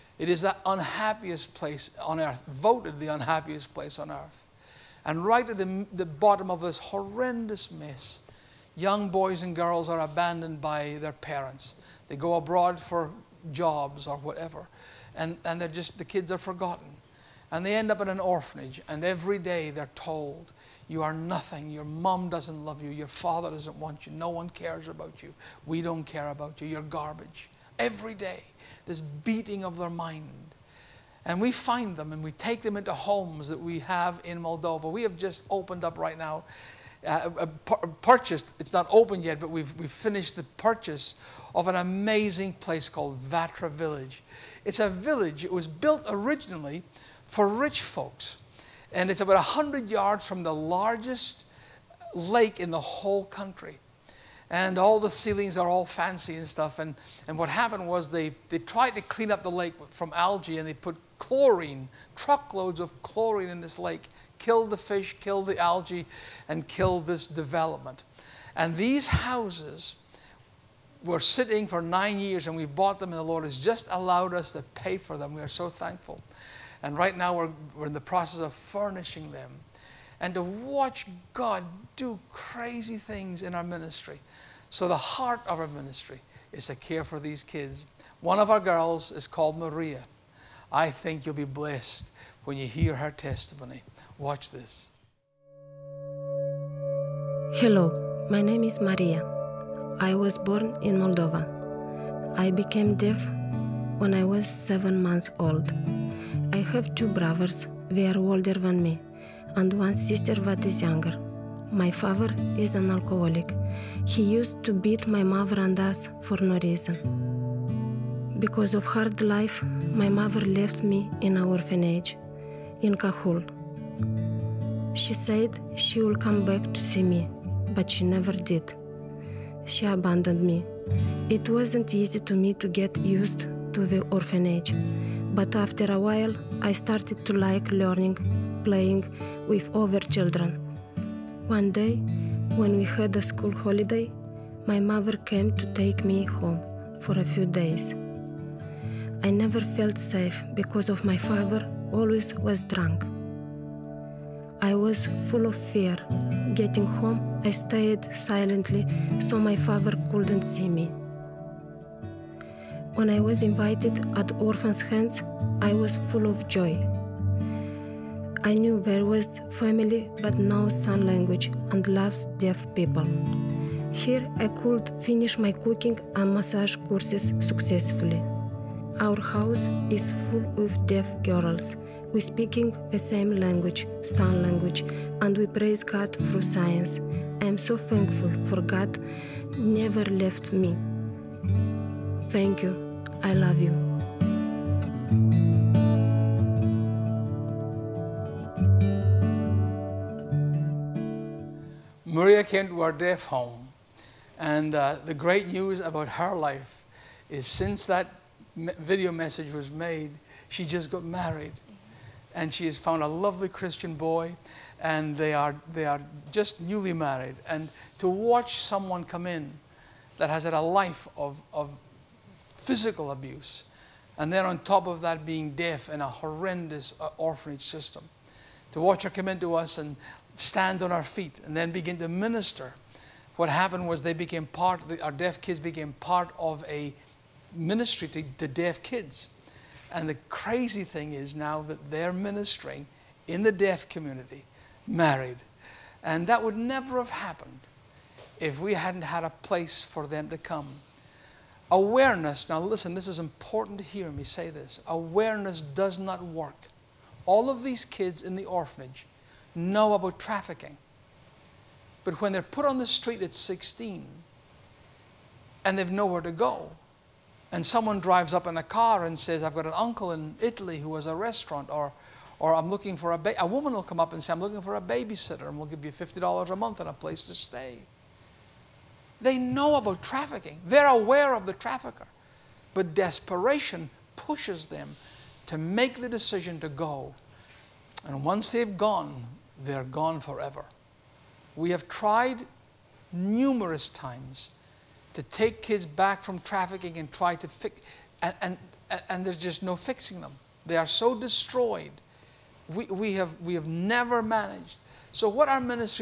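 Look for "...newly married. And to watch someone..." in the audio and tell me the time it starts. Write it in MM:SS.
03:36.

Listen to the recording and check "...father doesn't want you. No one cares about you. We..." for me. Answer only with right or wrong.
right.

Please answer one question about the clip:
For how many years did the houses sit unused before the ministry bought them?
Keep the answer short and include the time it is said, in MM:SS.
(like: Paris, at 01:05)
9, at 01:11.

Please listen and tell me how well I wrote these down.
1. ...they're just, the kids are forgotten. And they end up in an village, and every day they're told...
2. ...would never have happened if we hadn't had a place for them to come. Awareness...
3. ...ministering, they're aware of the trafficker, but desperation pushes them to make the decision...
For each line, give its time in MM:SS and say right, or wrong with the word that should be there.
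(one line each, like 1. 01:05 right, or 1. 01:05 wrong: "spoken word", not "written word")
1. 00:15 wrong: "orphanage", not "village"
2. 04:06 right
3. 04:40 wrong: "trafficking", not "ministering".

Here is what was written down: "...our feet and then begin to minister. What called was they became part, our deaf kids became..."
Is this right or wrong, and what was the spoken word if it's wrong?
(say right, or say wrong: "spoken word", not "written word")
wrong: "happened", not "called".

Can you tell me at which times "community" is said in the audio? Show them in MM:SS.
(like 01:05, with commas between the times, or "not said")
04:03.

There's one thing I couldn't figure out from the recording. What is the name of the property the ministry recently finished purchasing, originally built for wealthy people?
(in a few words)
Vatra Village.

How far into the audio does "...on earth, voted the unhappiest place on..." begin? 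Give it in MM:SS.
00:02.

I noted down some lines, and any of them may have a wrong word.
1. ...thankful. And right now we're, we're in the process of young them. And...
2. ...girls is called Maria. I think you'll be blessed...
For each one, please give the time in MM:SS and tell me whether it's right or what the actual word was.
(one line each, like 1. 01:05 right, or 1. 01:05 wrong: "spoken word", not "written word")
1. 01:15 wrong: "furnishing", not "young"
2. 01:28 right.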